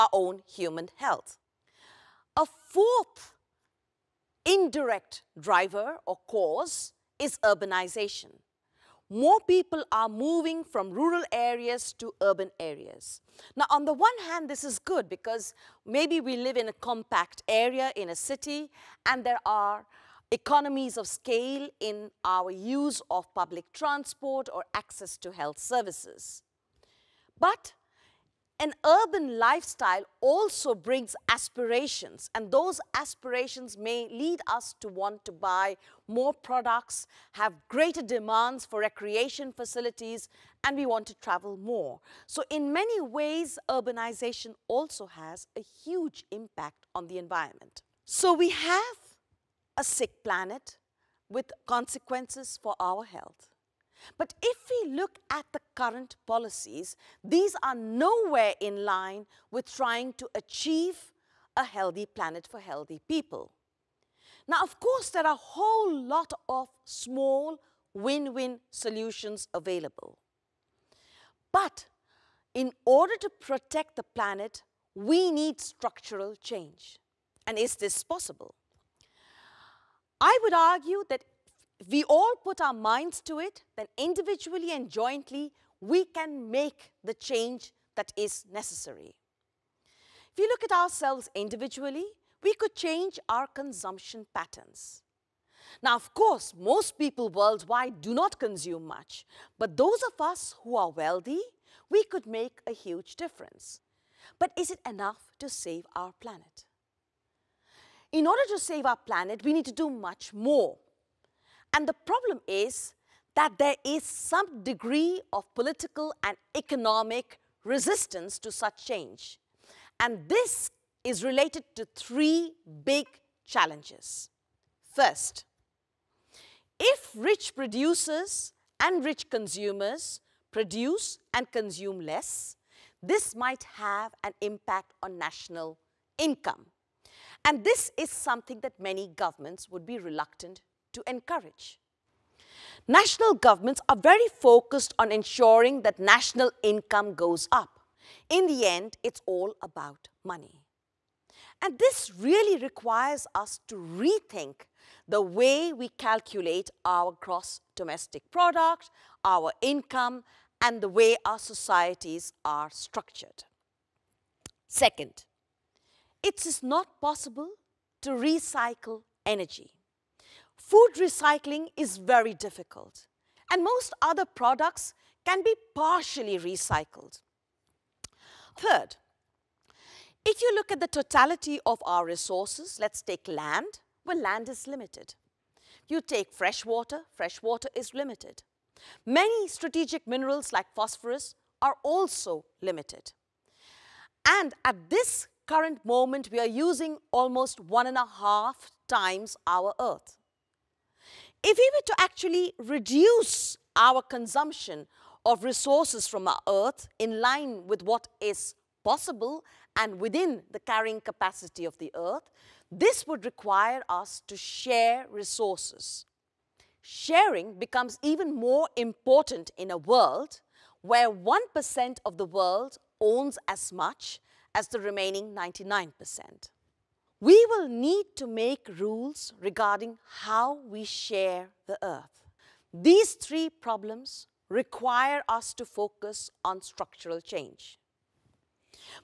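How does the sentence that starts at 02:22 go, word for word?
National governments are very focused on ensuring that national income goes up.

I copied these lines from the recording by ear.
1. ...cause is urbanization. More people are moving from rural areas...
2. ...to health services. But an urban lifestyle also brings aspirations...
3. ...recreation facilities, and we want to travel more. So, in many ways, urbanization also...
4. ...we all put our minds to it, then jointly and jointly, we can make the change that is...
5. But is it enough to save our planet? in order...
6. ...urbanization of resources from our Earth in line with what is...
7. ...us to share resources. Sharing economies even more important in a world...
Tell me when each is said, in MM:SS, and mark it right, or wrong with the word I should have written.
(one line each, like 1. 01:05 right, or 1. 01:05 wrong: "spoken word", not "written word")
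1. 00:06 right
2. 00:25 right
3. 00:38 right
4. 01:21 wrong: "individually", not "jointly"
5. 01:44 right
6. 03:23 wrong: "consumption", not "urbanization"
7. 03:33 wrong: "becomes", not "economies".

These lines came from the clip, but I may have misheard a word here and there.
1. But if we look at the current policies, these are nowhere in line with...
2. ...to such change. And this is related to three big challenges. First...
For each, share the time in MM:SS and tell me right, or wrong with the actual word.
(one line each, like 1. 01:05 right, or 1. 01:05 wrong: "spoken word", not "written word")
1. 00:54 right
2. 01:58 right.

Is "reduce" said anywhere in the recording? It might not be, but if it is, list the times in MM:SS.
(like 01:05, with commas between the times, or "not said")
03:22.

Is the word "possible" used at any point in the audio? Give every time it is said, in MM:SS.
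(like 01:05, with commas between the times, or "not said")
01:18, 02:46, 03:28.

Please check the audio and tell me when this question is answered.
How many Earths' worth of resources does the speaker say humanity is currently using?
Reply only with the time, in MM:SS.
03:17.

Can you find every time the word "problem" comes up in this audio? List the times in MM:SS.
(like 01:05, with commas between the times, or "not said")
01:51, 03:53.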